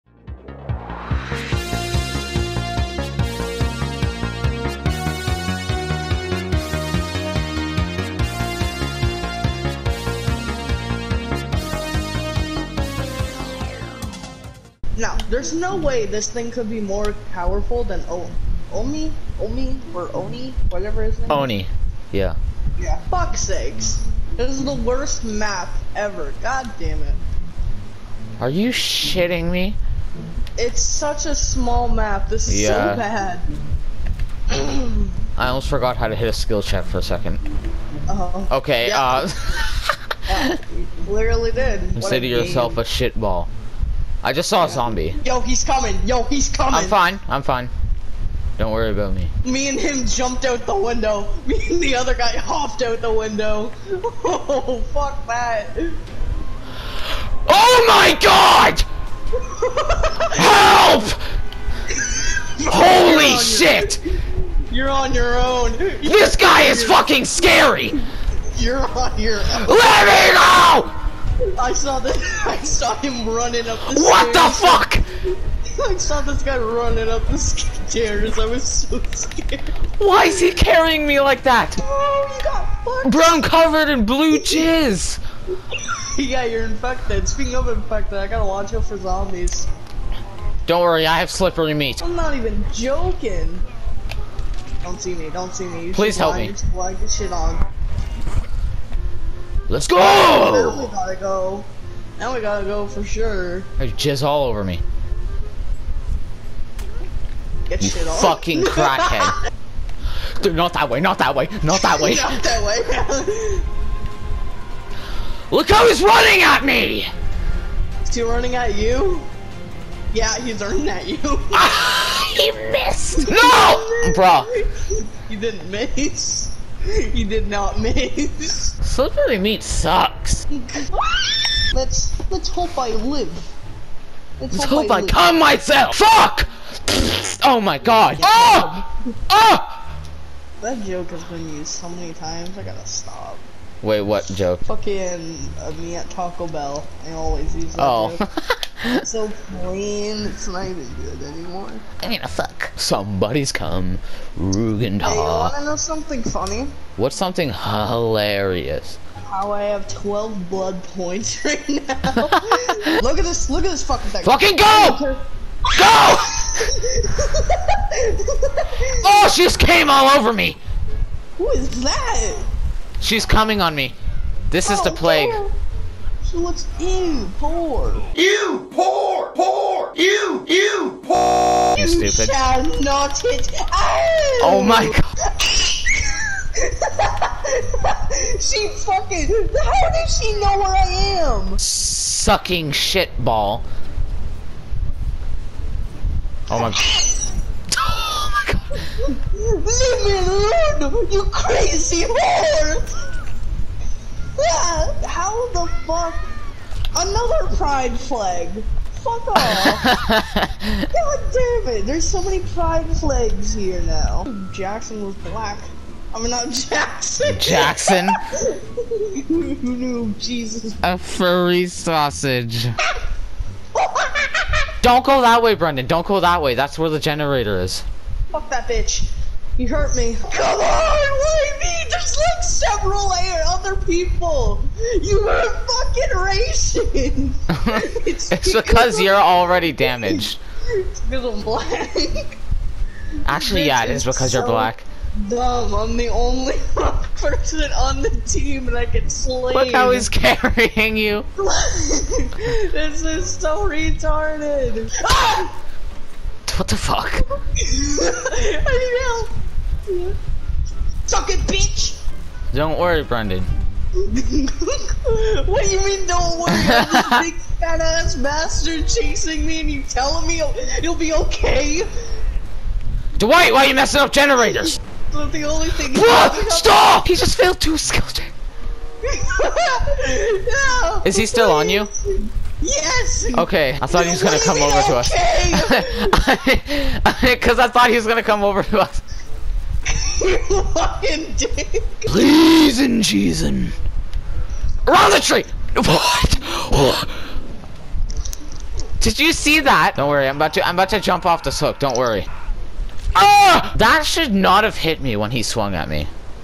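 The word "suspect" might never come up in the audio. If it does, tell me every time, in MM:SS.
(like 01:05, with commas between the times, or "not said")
not said.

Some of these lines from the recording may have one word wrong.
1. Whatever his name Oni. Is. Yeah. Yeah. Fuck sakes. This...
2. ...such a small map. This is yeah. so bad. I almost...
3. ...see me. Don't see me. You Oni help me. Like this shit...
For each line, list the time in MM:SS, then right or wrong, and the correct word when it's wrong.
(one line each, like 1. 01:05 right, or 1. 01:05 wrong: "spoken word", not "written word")
1. 00:20 right
2. 00:30 right
3. 01:35 wrong: "Please", not "Oni".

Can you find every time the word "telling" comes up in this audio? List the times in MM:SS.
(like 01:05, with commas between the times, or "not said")
04:29.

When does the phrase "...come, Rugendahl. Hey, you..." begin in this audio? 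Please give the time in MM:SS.
02:33.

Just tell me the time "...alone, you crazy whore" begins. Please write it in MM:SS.
03:20.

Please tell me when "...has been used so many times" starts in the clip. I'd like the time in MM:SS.
02:21.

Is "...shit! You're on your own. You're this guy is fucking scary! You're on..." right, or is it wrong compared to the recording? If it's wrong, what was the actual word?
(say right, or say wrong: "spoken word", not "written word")
right.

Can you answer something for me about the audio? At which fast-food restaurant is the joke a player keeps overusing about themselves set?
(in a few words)
Taco Bell.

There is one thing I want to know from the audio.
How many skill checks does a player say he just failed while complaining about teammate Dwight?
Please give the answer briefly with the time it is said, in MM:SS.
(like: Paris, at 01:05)
2, at 04:37.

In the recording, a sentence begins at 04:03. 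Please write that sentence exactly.
Actually, yeah, it is because so you're black.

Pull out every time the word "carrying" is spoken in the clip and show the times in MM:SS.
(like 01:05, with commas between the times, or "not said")
01:20, 04:10.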